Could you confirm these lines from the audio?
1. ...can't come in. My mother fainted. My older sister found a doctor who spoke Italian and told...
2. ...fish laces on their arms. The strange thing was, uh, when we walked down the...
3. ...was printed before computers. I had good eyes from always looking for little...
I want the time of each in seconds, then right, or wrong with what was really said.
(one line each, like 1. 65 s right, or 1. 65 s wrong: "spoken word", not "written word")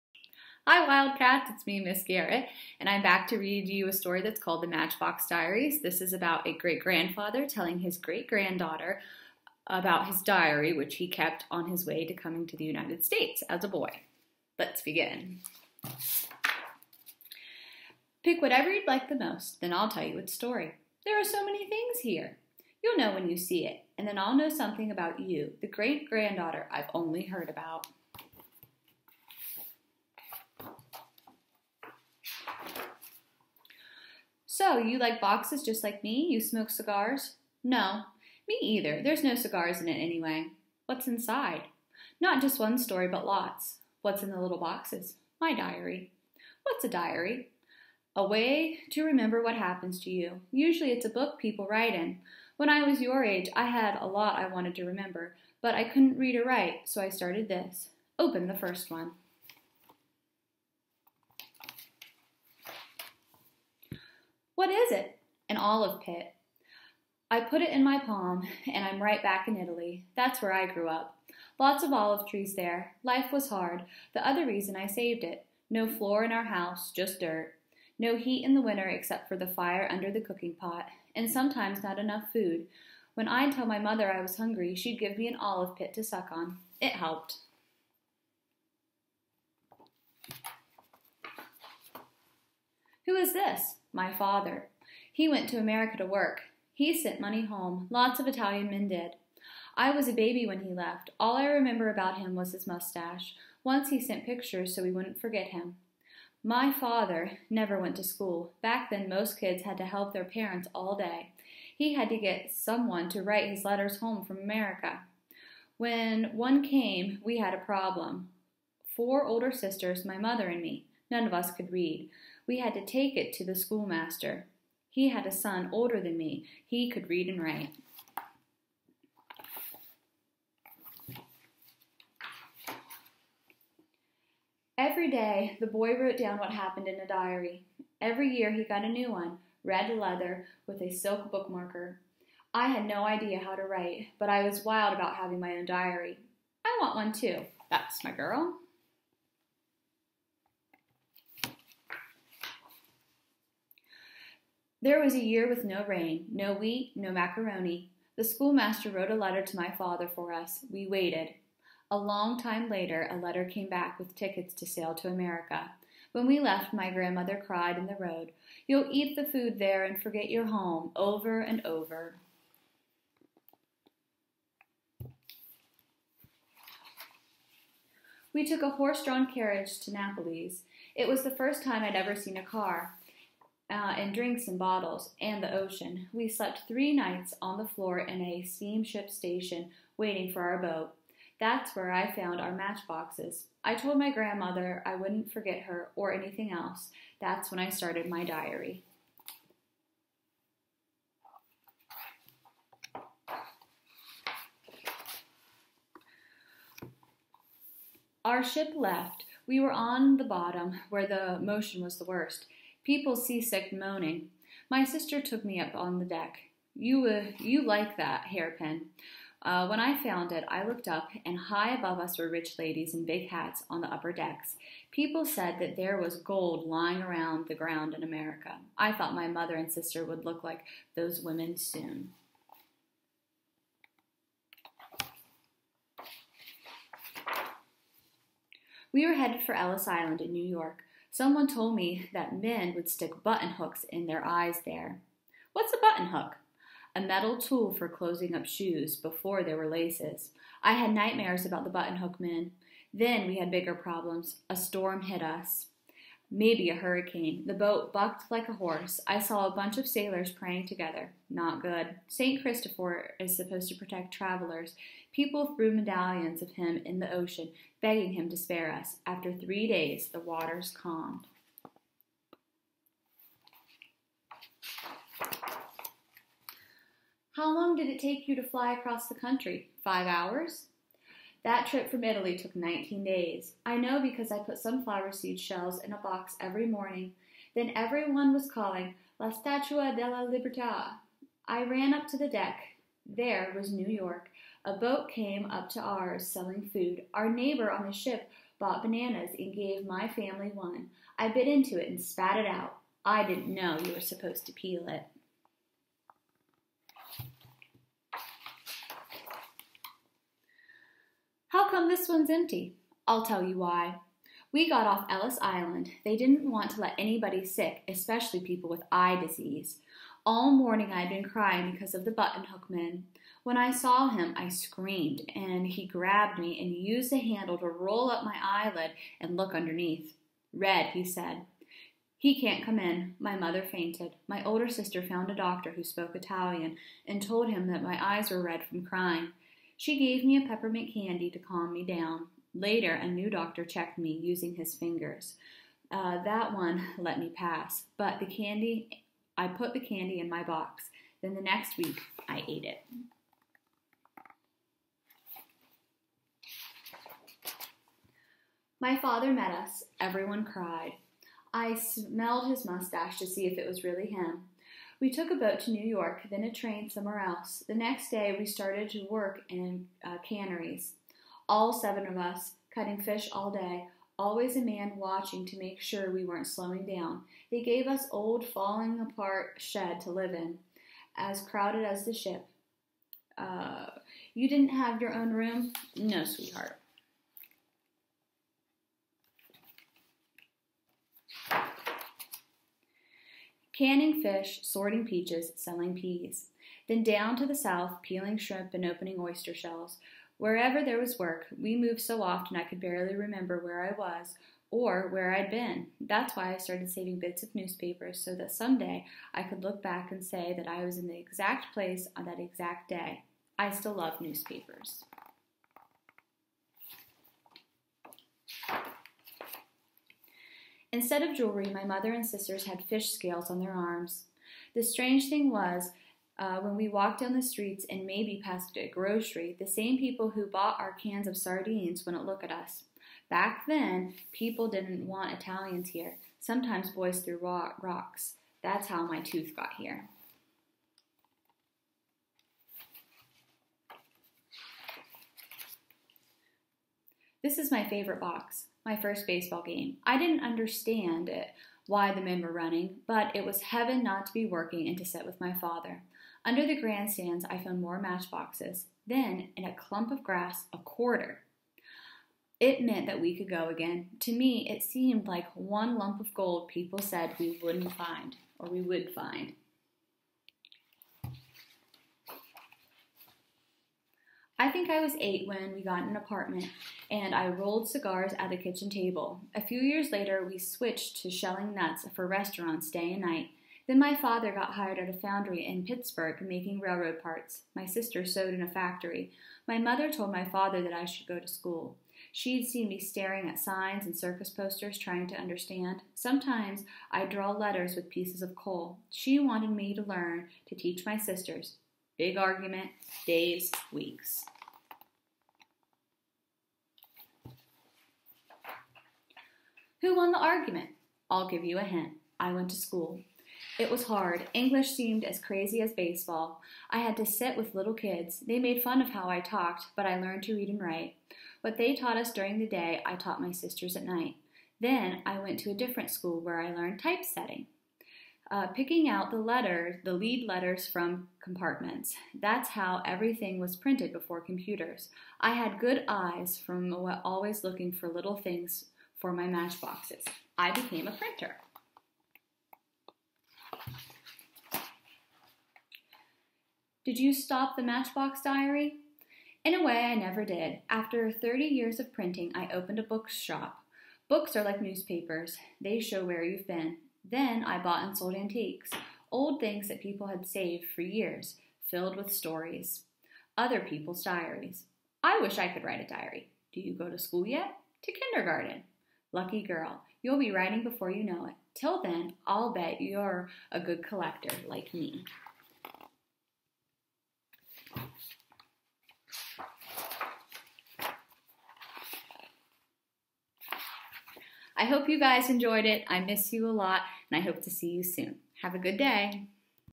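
1. 332 s right
2. 422 s wrong: "scales", not "laces"
3. 533 s right.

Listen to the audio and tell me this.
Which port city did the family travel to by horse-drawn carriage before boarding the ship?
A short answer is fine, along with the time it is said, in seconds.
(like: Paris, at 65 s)
Napoli, at 179 s.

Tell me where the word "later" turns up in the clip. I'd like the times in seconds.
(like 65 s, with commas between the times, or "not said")
162 s, 342 s, 480 s.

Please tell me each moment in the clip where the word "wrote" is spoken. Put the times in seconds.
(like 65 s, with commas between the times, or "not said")
135 s, 158 s.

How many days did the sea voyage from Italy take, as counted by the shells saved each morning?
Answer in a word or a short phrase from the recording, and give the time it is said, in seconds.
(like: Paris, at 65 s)
19, at 282 s.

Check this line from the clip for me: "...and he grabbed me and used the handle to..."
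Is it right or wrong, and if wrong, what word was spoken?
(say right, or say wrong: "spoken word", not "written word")
right.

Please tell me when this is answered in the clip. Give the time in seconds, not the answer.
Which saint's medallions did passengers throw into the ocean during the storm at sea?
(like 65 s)
262 s.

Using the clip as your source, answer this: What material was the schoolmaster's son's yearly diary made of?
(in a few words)
Red leather.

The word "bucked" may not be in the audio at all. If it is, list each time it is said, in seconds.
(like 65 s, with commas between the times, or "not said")
257 s.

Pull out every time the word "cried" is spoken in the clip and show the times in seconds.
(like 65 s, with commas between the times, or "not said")
167 s, 360 s.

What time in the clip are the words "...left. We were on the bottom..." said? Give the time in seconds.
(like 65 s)
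208 s.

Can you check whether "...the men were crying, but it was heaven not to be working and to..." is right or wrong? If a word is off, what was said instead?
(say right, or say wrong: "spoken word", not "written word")
wrong: "running", not "crying".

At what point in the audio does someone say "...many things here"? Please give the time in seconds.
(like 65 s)
21 s.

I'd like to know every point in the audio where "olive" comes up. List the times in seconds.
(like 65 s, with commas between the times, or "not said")
65 s, 71 s, 85 s.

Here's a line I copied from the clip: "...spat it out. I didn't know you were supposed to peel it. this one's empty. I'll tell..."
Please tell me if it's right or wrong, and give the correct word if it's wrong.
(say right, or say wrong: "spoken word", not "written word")
right.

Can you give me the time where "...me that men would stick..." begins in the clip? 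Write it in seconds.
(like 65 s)
241 s.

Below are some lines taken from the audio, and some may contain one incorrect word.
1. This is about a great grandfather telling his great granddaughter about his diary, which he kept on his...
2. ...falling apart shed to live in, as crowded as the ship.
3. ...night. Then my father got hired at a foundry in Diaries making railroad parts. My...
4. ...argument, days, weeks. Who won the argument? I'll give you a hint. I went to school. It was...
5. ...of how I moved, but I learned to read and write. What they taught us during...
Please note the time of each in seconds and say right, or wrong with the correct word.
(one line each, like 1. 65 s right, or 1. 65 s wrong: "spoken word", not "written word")
1. 5 s right
2. 378 s right
3. 483 s wrong: "Pittsburgh", not "Diaries"
4. 502 s right
5. 519 s wrong: "talked", not "moved".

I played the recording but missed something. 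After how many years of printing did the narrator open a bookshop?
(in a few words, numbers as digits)
30.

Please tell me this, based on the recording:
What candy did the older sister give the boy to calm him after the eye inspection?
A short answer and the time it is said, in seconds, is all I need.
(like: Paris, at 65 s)
Peppermint, at 340 s.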